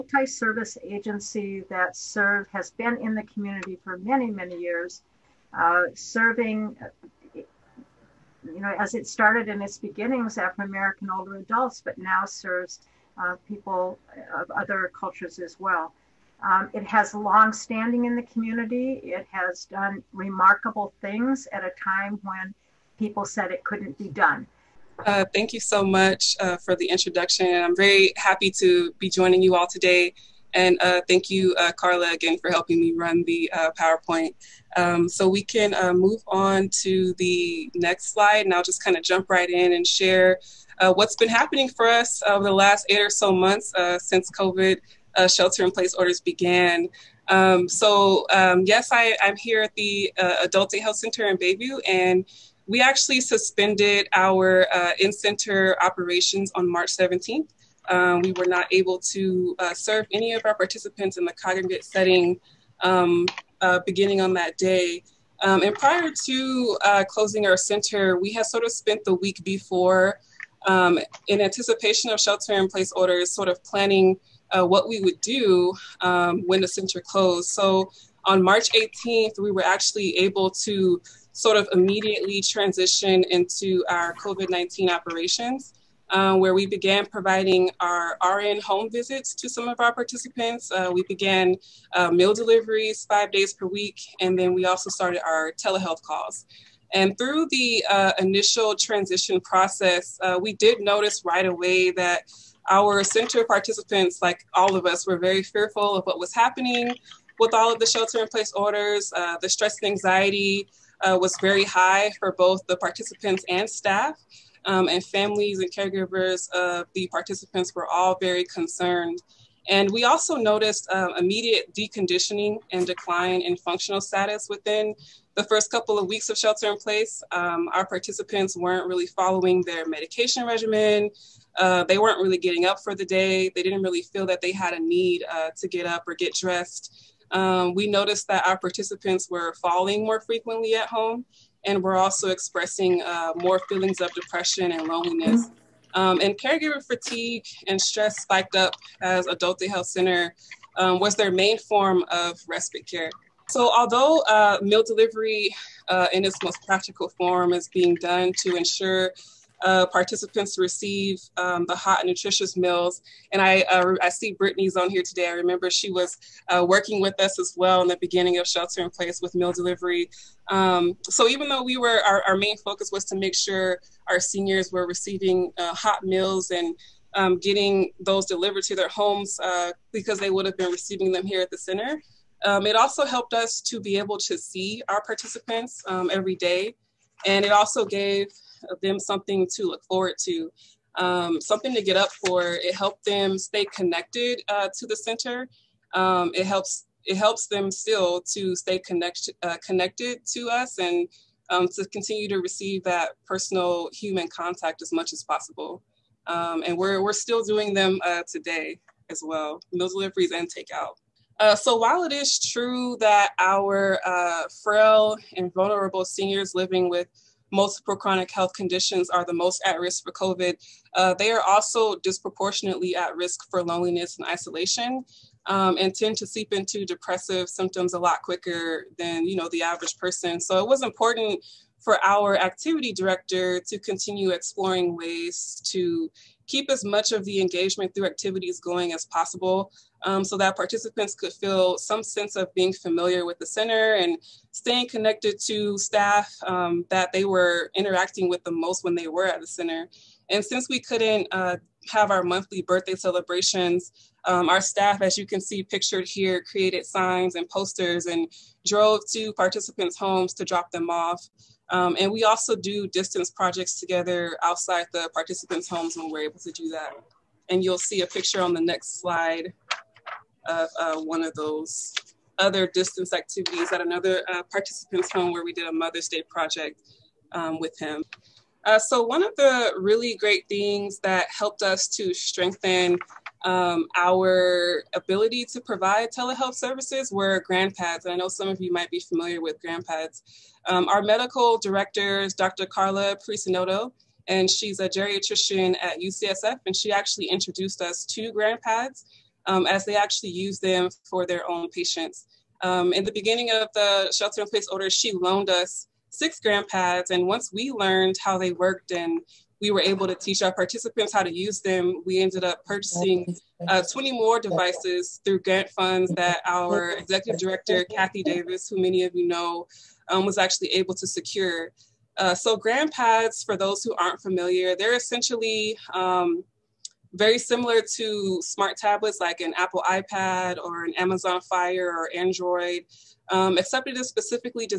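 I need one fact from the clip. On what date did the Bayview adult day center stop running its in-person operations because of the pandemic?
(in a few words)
March 17.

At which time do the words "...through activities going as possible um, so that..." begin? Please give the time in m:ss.
3:57.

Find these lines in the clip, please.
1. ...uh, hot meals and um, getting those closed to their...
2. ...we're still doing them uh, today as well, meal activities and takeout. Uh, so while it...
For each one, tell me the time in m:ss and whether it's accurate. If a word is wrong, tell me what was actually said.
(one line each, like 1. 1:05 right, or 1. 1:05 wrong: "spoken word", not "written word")
1. 2:55 wrong: "delivered", not "closed"
2. 3:27 wrong: "deliveries", not "activities".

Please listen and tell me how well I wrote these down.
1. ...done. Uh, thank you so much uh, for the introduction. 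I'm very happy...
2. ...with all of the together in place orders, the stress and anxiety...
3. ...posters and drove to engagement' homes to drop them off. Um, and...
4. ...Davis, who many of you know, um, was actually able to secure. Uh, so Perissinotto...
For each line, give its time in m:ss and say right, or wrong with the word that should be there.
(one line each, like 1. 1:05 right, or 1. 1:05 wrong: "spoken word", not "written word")
1. 0:24 right
2. 1:47 wrong: "shelter", not "together"
3. 4:17 wrong: "participants", not "engagement"
4. 5:18 wrong: "GrandPads", not "Perissinotto".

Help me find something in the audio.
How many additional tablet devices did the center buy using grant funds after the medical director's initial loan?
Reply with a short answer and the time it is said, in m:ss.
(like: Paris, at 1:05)
20, at 5:13.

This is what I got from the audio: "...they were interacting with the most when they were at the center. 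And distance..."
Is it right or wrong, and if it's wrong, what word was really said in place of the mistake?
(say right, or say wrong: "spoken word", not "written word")
wrong: "since", not "distance".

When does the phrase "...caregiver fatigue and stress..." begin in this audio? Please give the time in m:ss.
2:26.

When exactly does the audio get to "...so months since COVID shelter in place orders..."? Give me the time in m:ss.
0:43.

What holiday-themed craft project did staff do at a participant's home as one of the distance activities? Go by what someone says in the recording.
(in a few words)
Mother's Day project.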